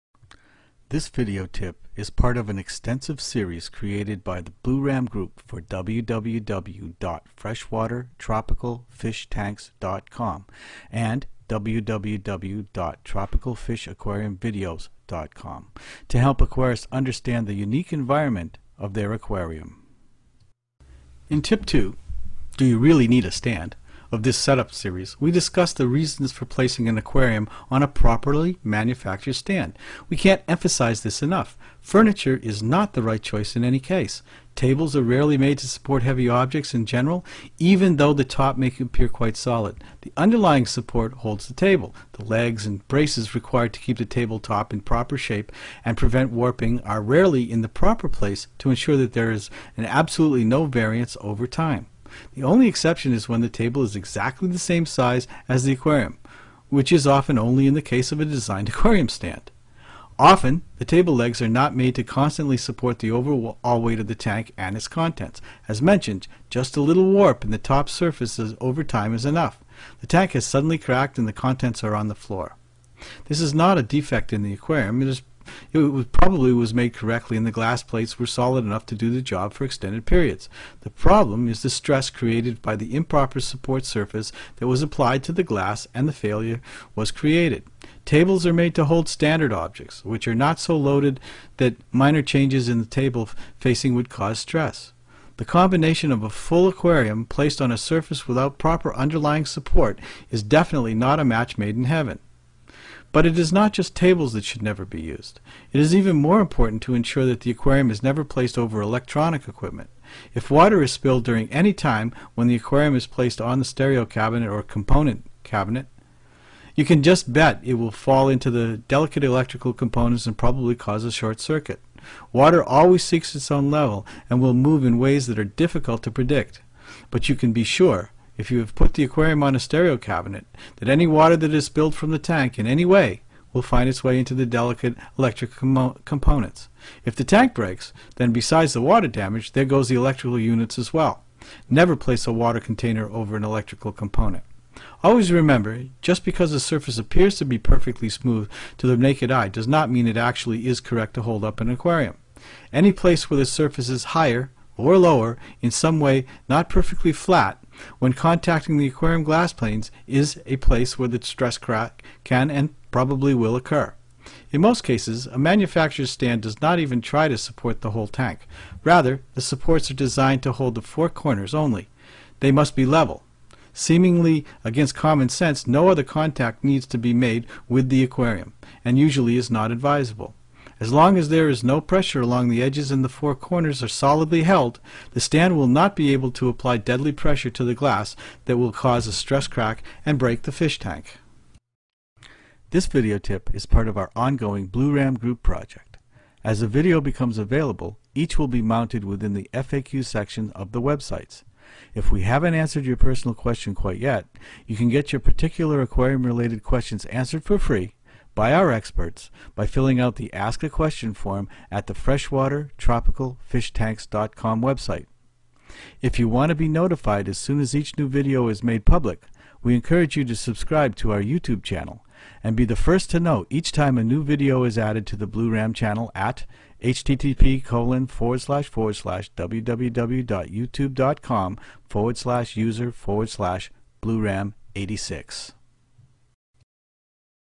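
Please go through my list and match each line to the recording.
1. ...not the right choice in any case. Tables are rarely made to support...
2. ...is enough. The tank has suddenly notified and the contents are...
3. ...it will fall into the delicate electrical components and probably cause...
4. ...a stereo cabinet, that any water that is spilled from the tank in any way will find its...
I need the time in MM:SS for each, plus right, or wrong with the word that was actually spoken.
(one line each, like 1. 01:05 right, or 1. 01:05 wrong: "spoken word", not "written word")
1. 00:32 right
2. 01:09 wrong: "cracked", not "notified"
3. 01:57 right
4. 02:09 right.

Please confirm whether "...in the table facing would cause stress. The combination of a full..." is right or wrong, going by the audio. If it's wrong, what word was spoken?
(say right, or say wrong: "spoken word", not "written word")
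right.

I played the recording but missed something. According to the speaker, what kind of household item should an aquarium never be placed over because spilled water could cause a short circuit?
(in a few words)
Electronic equipment.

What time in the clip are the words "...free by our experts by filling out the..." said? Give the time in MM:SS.
03:27.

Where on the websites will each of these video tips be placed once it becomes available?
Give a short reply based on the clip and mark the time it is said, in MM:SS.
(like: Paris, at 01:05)
FAQ section, at 03:19.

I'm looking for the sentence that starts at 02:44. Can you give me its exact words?
In most cases, a manufacturer's stand does not even try to support the whole tank.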